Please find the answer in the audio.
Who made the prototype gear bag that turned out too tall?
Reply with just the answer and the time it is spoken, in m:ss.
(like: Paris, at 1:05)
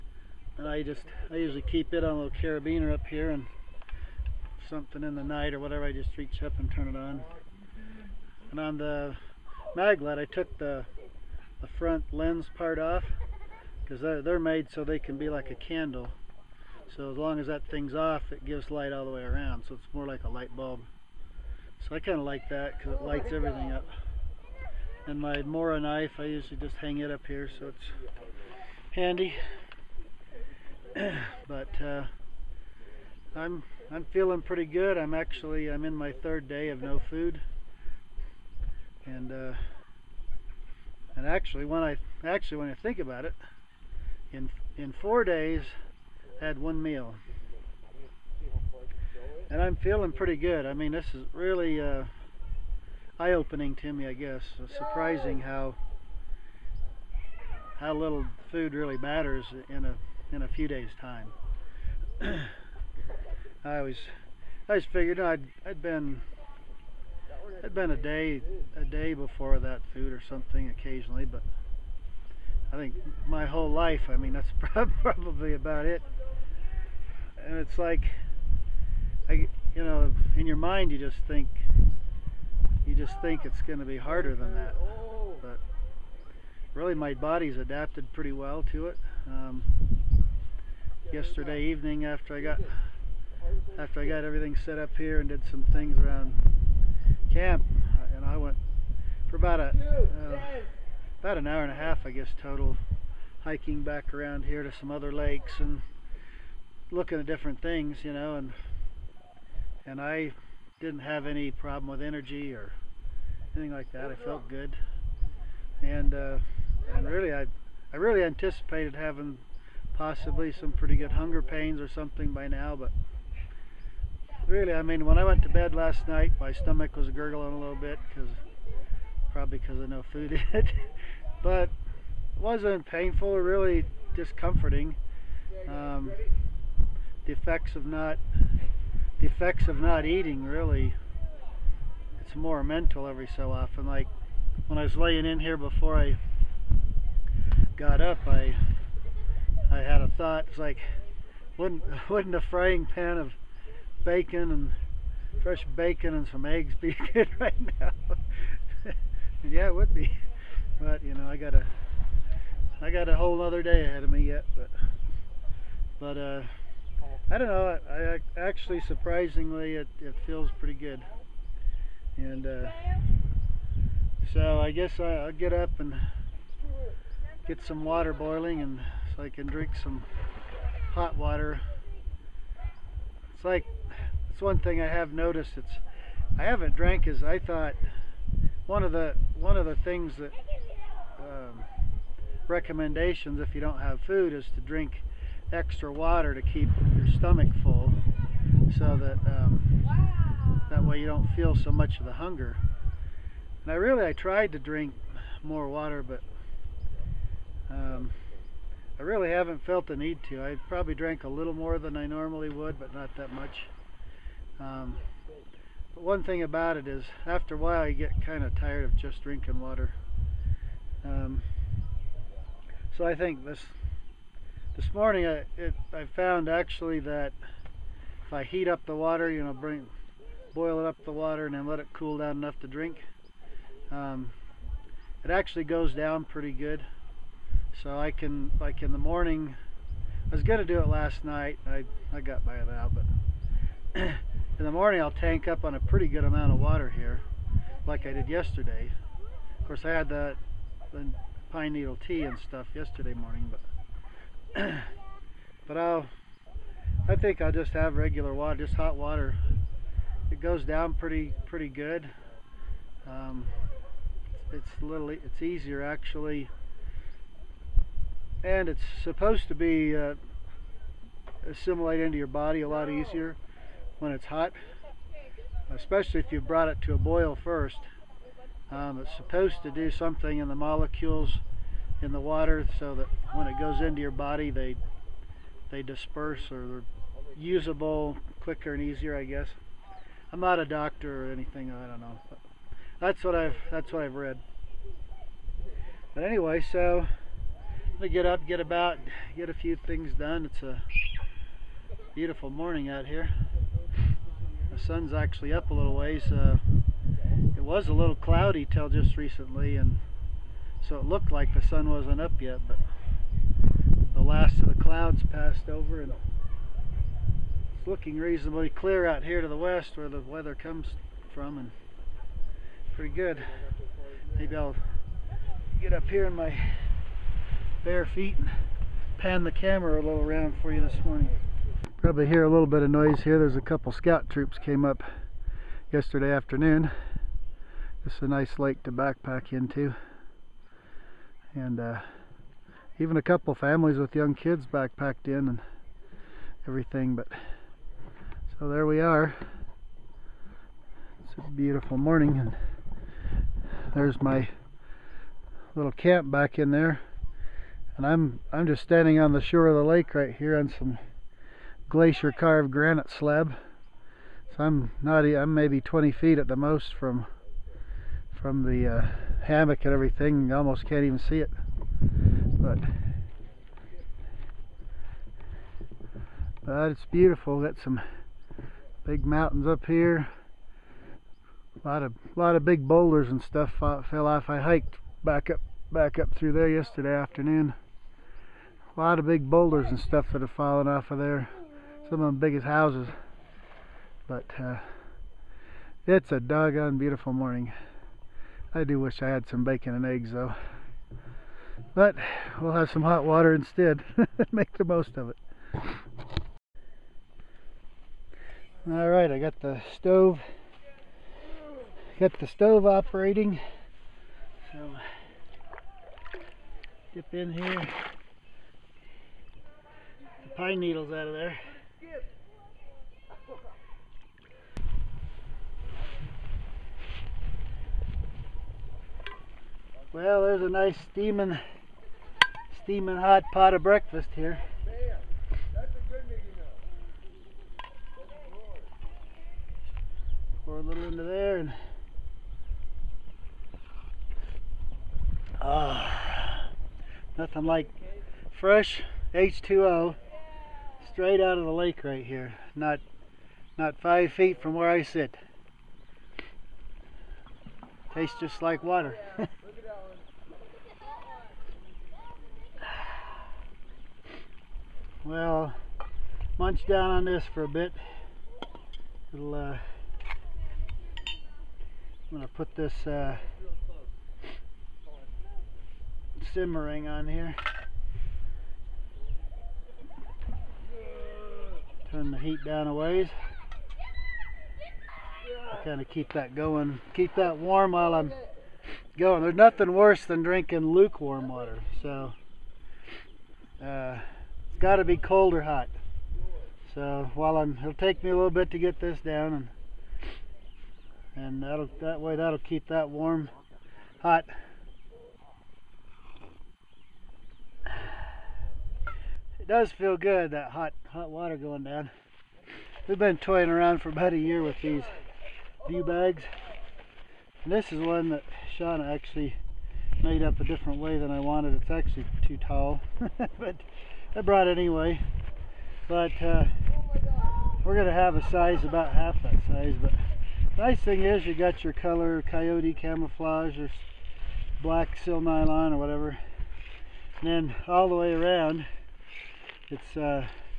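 Shauna, at 8:38.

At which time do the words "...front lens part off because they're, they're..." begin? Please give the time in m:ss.
0:11.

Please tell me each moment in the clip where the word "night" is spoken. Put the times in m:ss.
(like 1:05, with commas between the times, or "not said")
0:05, 2:06, 4:01.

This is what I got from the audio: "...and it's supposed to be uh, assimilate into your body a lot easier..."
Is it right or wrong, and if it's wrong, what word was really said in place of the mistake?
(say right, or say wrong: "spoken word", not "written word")
right.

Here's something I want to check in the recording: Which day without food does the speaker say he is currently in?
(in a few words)
third day.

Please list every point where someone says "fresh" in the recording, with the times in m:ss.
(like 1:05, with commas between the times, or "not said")
2:35, 7:28.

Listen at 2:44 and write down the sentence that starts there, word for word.
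But but uh, I don't know.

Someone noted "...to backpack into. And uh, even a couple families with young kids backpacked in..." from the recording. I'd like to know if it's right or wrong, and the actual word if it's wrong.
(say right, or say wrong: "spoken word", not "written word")
right.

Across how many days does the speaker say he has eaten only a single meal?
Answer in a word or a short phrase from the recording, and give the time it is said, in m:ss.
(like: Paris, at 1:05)
4, at 0:45.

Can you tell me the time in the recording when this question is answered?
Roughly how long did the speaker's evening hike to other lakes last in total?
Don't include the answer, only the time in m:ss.
1:41.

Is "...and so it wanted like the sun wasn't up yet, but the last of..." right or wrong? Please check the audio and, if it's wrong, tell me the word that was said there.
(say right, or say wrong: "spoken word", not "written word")
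wrong: "looked", not "wanted".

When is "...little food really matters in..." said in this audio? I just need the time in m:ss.
0:57.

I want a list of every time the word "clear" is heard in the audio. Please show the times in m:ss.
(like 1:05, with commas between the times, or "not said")
5:18.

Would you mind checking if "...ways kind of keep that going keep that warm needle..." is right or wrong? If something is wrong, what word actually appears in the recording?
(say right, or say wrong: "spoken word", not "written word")
wrong: "while", not "needle".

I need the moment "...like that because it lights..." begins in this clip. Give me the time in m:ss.
0:22.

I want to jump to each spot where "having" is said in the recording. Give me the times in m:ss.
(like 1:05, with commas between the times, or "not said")
1:58.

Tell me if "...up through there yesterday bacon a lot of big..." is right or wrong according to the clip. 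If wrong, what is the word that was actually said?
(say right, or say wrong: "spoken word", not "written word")
wrong: "afternoon", not "bacon".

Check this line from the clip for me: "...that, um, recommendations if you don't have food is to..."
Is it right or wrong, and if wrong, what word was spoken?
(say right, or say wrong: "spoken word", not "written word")
right.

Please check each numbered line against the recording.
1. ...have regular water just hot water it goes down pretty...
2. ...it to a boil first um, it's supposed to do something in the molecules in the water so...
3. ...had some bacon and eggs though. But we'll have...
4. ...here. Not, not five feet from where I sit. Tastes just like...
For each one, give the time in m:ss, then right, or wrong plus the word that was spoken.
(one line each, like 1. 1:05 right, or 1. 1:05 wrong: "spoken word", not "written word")
1. 4:17 right
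2. 4:36 right
3. 6:39 right
4. 7:32 right.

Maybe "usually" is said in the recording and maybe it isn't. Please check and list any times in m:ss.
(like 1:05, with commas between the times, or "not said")
0:01, 0:26.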